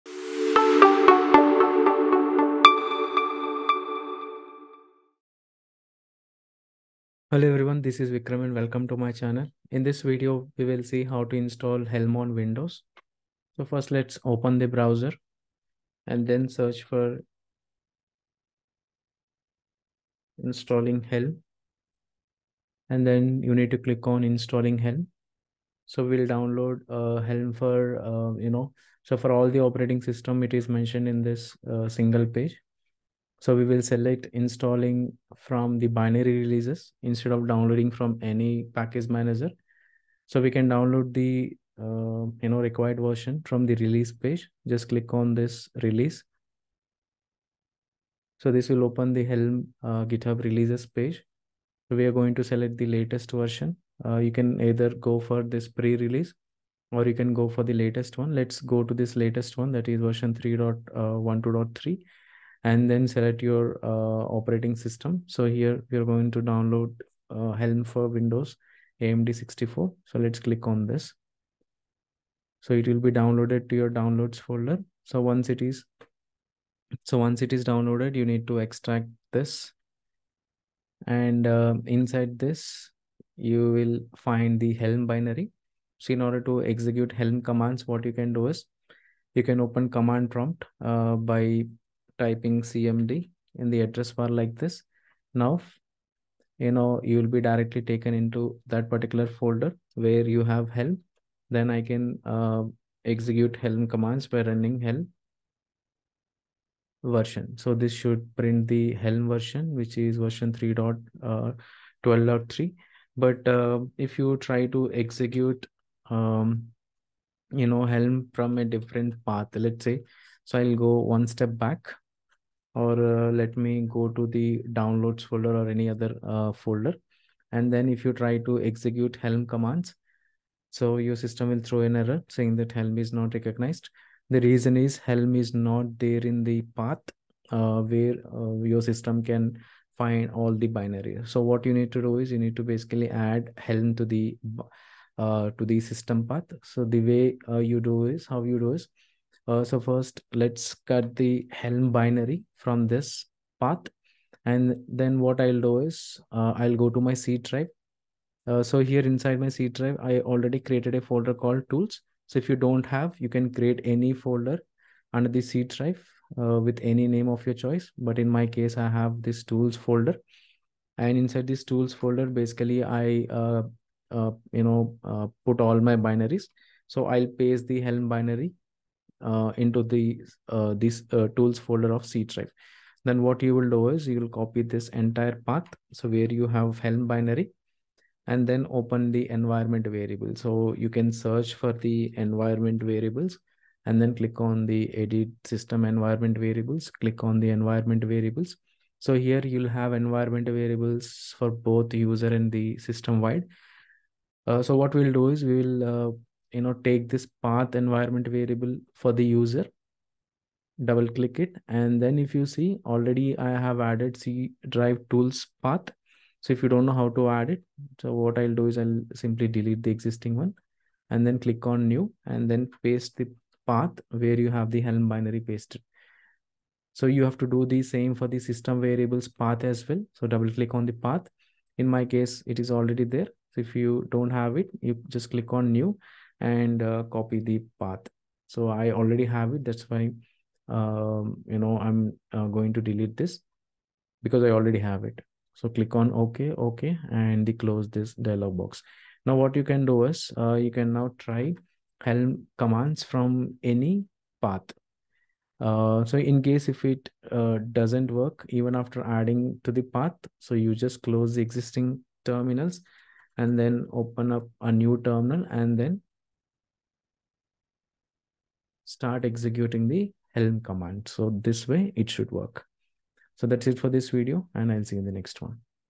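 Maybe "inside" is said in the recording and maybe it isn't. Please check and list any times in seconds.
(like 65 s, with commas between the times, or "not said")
81 s, 159 s, 171 s.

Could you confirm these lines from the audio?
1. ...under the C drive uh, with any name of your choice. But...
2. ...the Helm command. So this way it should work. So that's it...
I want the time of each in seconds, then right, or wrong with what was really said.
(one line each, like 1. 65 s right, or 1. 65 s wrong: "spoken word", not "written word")
1. 165 s right
2. 269 s right.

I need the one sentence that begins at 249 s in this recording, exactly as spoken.
Now what you can do is uh, you can now try Helm commands from any path.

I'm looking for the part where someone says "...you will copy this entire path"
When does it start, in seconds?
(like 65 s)
184 s.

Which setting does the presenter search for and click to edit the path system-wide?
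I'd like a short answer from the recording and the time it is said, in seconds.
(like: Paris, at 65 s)
edit system environment variables, at 194 s.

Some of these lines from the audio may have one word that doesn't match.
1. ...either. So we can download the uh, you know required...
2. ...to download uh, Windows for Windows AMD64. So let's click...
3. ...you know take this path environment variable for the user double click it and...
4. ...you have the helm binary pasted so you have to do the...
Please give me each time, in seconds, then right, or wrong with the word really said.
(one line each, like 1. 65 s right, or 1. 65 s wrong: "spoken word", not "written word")
1. 39 s wrong: "manager", not "either"
2. 66 s wrong: "Helm", not "Windows"
3. 206 s right
4. 224 s right.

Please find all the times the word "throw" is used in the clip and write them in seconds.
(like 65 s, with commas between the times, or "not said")
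131 s.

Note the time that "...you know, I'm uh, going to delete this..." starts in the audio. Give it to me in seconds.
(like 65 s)
241 s.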